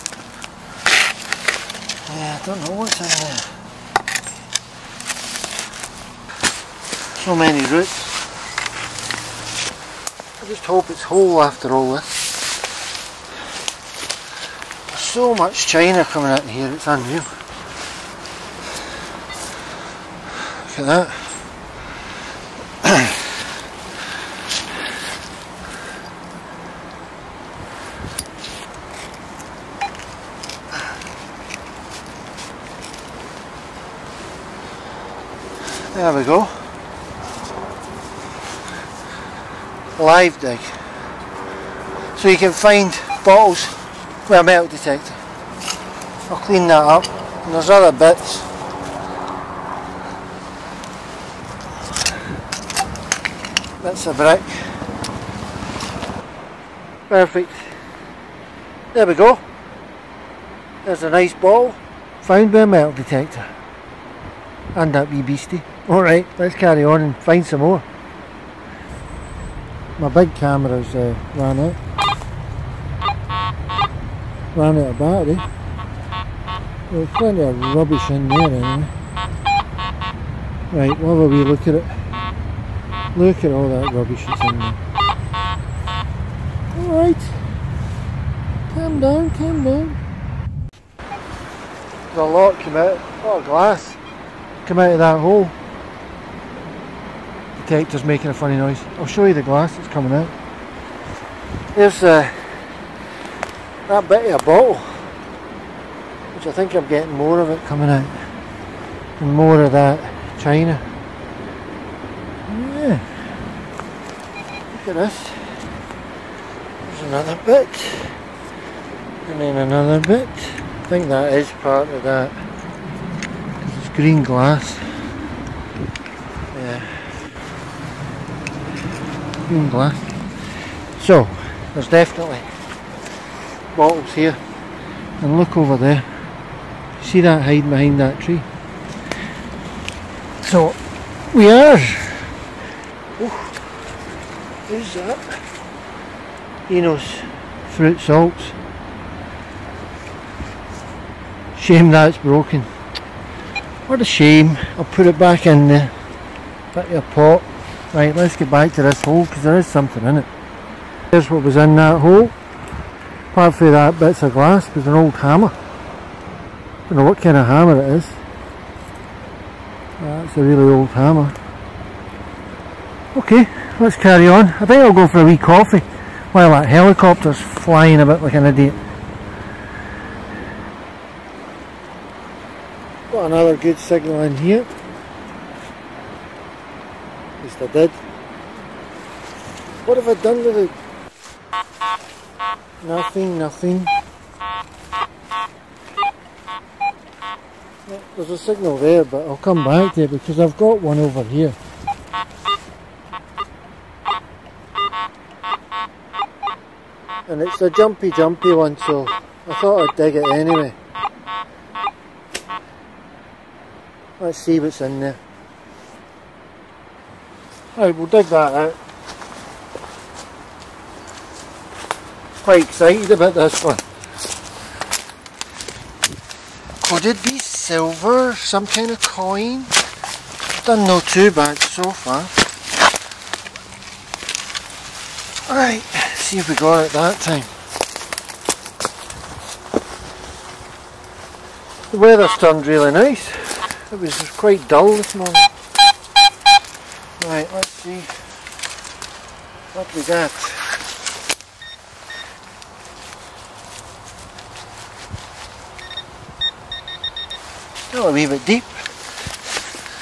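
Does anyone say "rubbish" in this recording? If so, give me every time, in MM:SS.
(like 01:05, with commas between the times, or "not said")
01:17, 01:23.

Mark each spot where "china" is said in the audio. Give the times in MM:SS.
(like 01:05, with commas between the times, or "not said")
00:15, 01:50.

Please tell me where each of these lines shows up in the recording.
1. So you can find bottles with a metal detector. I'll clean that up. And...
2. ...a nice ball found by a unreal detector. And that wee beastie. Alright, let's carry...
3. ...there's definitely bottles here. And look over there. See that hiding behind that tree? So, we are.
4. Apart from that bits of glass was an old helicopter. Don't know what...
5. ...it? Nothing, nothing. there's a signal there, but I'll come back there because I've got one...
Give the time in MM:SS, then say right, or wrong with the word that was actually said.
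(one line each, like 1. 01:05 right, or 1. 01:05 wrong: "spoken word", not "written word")
1. 00:42 right
2. 01:01 wrong: "metal", not "unreal"
3. 02:11 right
4. 02:43 wrong: "hammer", not "helicopter"
5. 03:10 right.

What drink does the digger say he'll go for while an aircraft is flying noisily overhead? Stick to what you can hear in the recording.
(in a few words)
Coffee.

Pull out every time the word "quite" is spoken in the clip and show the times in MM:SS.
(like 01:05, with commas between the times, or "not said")
03:42, 04:04.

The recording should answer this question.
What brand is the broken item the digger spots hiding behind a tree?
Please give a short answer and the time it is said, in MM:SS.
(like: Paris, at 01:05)
Eno's fruit salts, at 02:26.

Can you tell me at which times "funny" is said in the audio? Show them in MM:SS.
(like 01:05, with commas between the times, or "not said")
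01:38.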